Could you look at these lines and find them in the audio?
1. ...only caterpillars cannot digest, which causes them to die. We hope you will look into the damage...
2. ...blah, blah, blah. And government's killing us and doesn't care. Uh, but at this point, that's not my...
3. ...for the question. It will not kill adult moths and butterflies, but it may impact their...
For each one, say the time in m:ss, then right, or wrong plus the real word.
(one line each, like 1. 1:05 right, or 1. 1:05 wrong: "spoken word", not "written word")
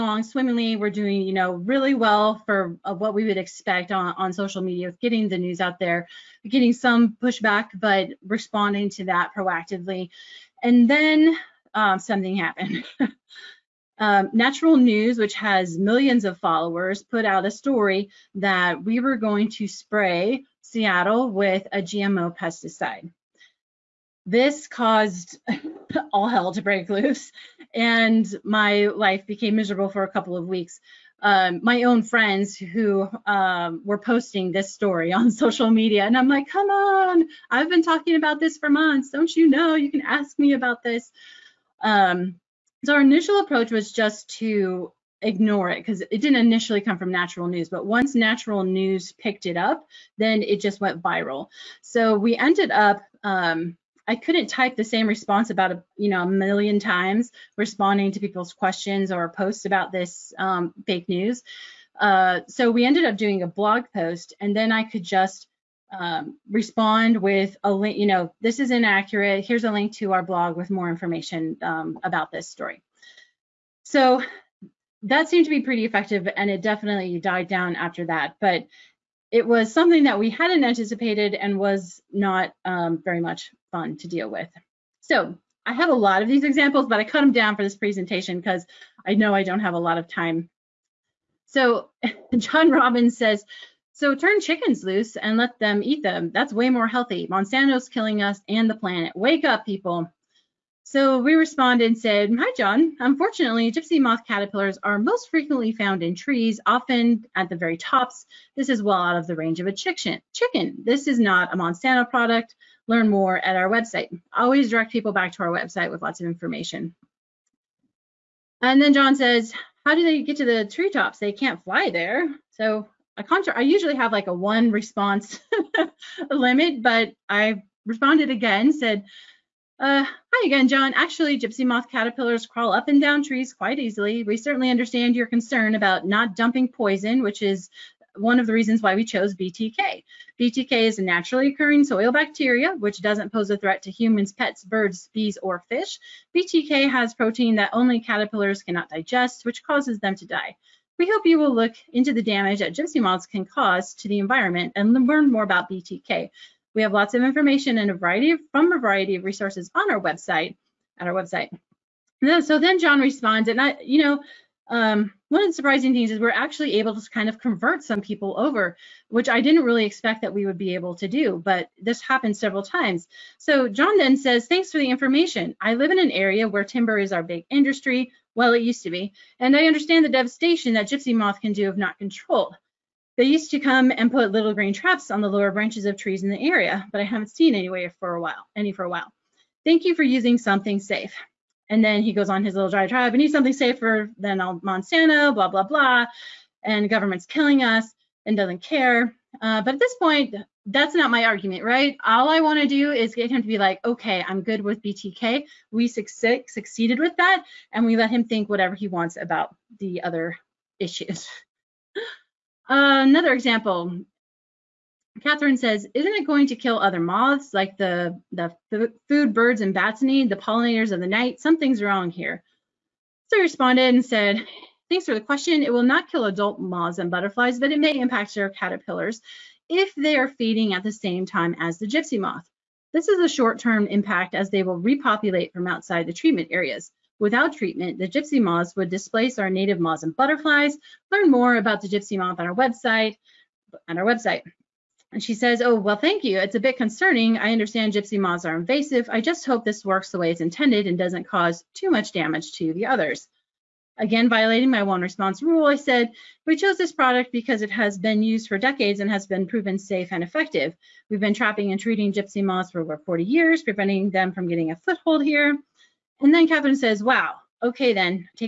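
1. 2:27 right
2. 3:15 right
3. 3:45 right.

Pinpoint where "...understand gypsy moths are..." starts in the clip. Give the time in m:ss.
4:07.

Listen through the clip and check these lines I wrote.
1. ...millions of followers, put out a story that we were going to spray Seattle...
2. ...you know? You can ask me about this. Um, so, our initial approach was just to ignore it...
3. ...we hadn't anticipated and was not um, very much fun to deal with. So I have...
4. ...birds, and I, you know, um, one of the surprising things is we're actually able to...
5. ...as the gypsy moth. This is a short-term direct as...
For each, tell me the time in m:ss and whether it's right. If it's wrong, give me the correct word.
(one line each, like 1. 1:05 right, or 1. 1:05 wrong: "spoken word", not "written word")
1. 0:15 right
2. 0:39 right
3. 1:20 right
4. 2:43 wrong: "responds", not "birds"
5. 3:51 wrong: "impact", not "direct".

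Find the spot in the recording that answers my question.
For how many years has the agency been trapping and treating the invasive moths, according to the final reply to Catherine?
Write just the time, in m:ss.
4:22.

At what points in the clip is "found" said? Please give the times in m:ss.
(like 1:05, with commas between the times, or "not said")
1:45.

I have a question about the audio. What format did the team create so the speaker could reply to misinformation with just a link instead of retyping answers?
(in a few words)
blog post.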